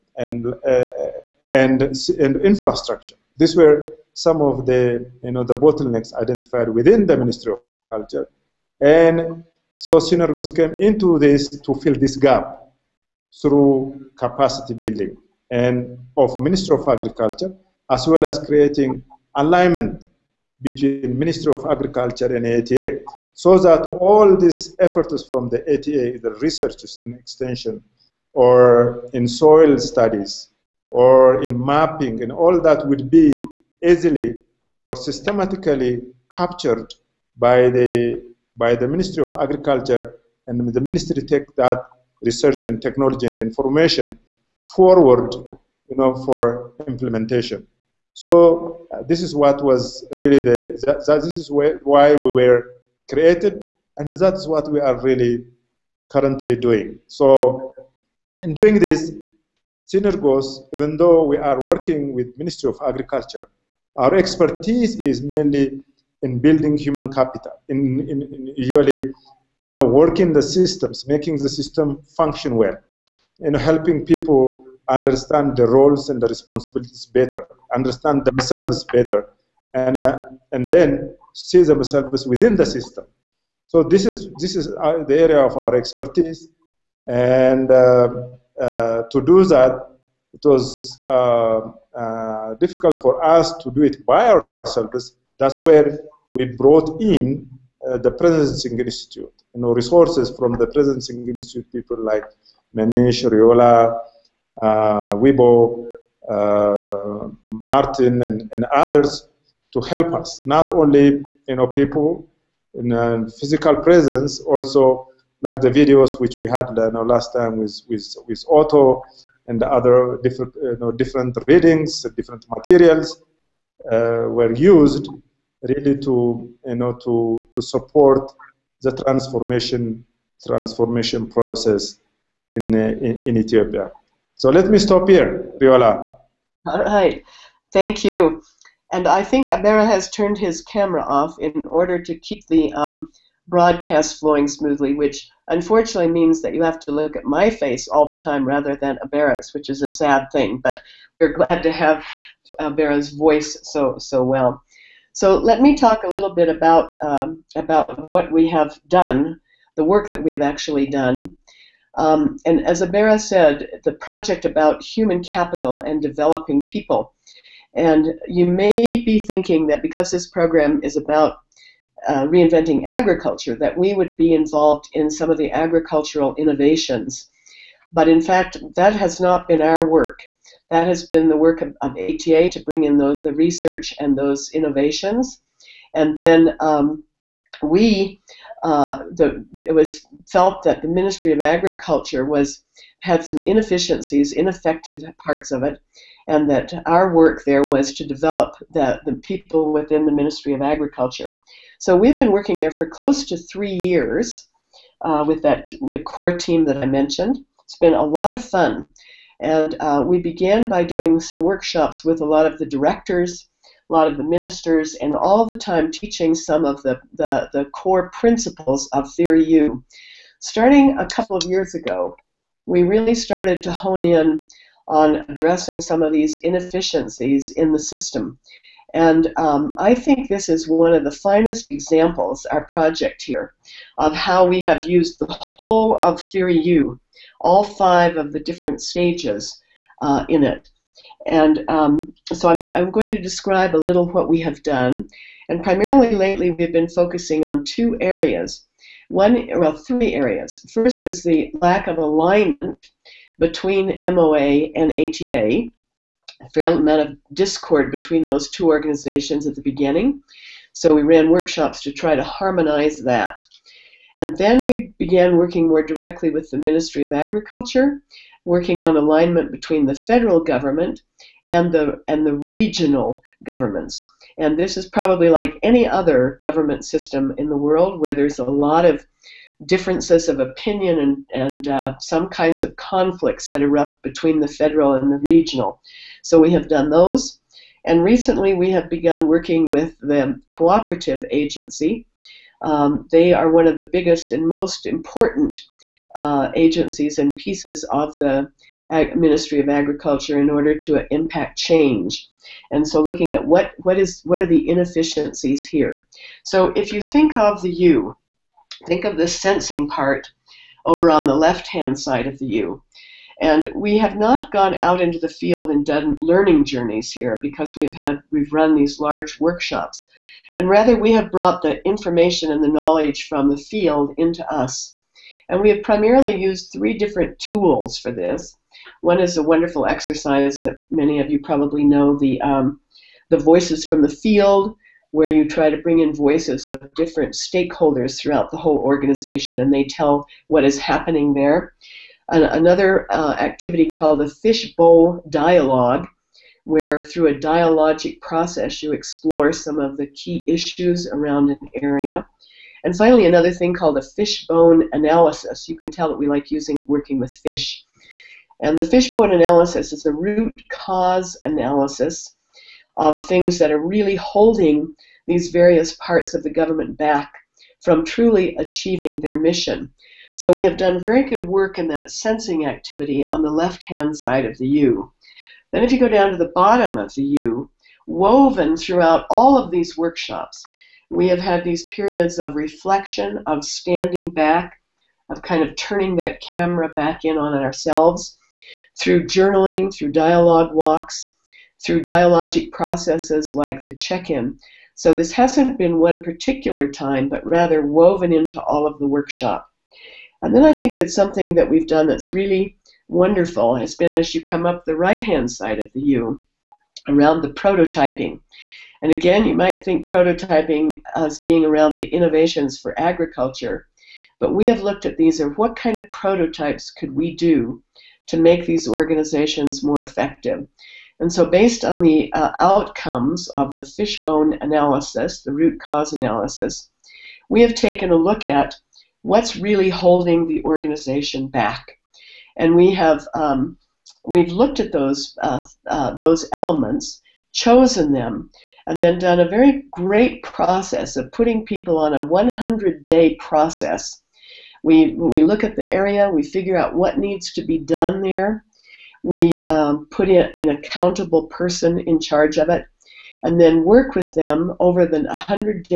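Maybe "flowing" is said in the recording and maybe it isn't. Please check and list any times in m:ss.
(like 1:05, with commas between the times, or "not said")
2:24.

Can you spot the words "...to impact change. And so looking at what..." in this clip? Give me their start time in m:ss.
5:00.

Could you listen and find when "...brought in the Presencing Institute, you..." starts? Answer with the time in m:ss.
1:36.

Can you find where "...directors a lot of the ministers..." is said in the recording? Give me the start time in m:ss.
3:32.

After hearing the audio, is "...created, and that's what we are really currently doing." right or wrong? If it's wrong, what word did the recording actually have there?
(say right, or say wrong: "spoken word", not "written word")
right.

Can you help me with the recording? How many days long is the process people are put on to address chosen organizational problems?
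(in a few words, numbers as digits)
100.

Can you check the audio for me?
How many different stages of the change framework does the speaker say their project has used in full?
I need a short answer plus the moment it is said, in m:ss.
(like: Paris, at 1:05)
5, at 3:57.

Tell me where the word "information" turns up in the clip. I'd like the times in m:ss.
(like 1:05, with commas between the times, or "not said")
0:43, 5:21.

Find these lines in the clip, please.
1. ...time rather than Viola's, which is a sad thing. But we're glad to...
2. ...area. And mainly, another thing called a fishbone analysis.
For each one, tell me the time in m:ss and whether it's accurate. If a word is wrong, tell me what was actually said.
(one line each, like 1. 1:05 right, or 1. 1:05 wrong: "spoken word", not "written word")
1. 2:28 wrong: "Abera", not "Viola"
2. 5:51 wrong: "finally", not "mainly".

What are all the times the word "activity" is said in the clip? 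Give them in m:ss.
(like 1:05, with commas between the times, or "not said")
5:43, 6:12.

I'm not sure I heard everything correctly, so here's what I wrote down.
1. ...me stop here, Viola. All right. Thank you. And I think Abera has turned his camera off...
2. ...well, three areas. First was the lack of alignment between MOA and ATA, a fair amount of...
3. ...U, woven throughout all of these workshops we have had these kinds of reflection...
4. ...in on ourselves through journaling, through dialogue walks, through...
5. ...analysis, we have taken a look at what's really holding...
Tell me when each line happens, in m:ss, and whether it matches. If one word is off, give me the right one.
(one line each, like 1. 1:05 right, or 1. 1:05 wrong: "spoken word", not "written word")
1. 2:14 right
2. 4:09 right
3. 6:17 wrong: "periods", not "kinds"
4. 6:27 right
5. 7:06 right.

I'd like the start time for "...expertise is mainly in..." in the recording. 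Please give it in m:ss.
1:04.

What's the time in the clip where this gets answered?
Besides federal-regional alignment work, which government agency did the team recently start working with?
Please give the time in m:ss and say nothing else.
4:50.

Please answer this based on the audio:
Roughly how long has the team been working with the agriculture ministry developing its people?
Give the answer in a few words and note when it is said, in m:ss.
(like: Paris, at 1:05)
close to 3 years, at 3:22.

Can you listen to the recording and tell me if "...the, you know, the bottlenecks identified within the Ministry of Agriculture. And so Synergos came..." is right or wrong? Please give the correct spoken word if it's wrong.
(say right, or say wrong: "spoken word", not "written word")
right.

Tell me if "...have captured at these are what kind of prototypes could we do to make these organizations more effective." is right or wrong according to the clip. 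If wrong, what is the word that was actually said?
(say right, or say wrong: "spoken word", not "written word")
wrong: "looked", not "captured".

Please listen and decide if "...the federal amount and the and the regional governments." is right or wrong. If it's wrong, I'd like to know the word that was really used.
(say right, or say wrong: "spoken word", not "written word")
wrong: "government", not "amount".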